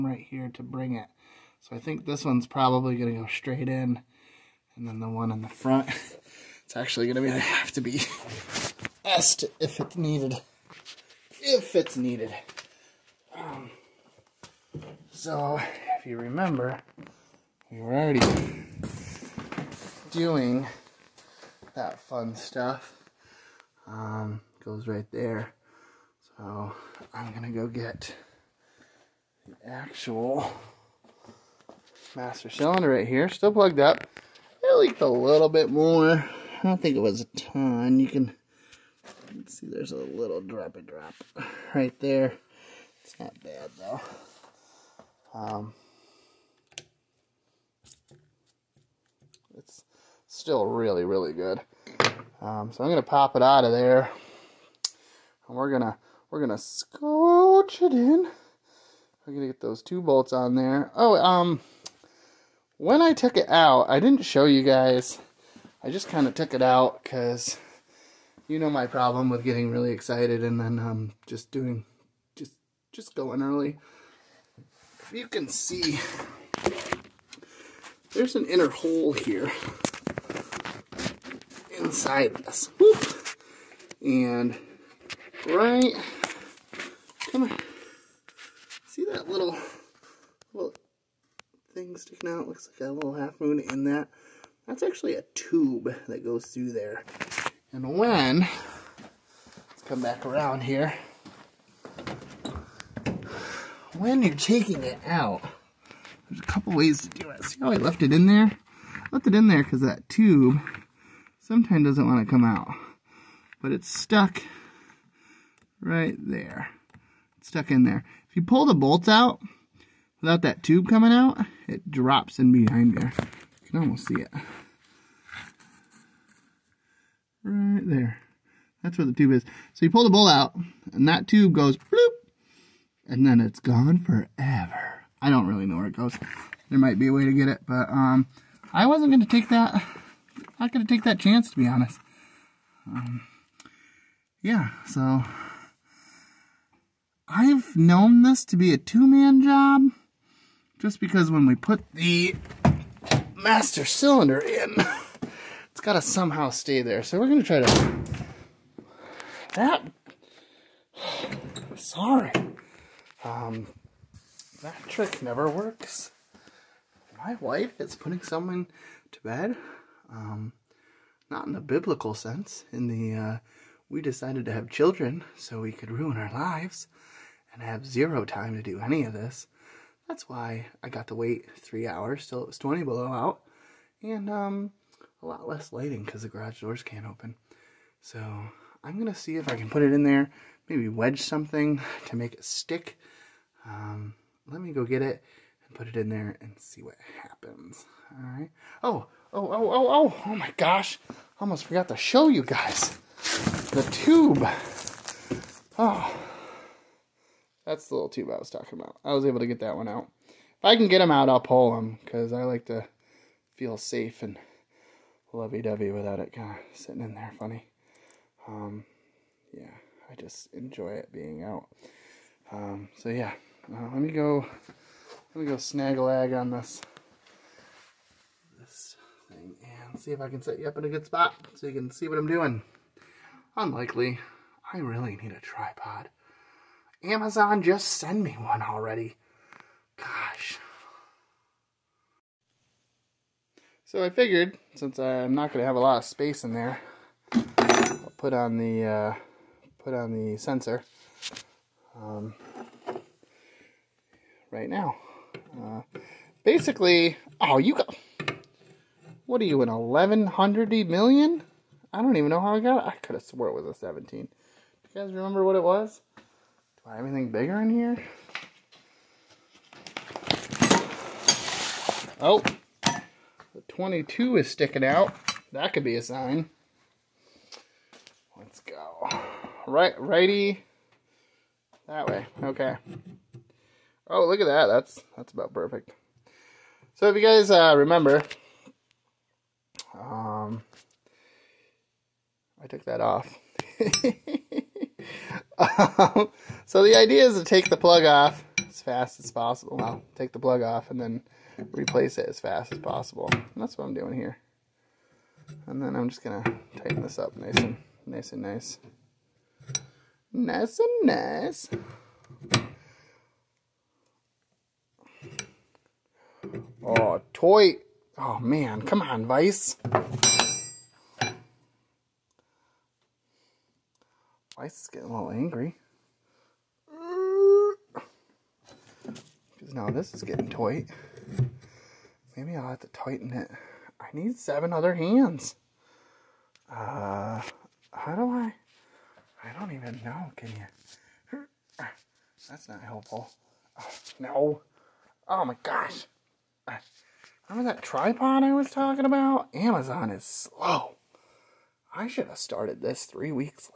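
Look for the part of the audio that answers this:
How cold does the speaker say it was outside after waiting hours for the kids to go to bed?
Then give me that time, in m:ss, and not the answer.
3:02.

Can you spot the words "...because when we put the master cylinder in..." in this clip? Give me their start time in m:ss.
2:30.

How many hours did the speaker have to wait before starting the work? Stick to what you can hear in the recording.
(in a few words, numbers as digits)
3.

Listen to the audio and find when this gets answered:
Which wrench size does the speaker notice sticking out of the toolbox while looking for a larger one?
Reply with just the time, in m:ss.
4:33.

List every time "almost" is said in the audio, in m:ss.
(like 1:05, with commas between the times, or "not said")
2:03, 3:21.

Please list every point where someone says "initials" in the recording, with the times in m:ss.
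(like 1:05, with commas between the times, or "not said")
not said.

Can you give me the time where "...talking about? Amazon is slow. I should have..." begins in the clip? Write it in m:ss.
5:48.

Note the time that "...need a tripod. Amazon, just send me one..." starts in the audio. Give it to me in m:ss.
3:55.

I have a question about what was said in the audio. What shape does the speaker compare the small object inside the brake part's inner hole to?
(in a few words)
Half moon.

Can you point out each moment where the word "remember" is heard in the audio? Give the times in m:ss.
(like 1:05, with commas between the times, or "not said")
0:16, 4:25, 4:47, 5:47.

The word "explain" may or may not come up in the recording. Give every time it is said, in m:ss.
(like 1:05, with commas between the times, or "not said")
not said.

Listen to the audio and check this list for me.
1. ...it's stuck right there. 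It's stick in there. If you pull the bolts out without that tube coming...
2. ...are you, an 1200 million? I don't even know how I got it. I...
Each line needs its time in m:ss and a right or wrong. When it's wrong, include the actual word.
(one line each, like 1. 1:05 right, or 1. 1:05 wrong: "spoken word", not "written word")
1. 1:53 wrong: "stuck", not "stick"
2. 4:19 wrong: "1100", not "1200".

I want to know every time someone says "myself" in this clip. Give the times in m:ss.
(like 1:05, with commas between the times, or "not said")
not said.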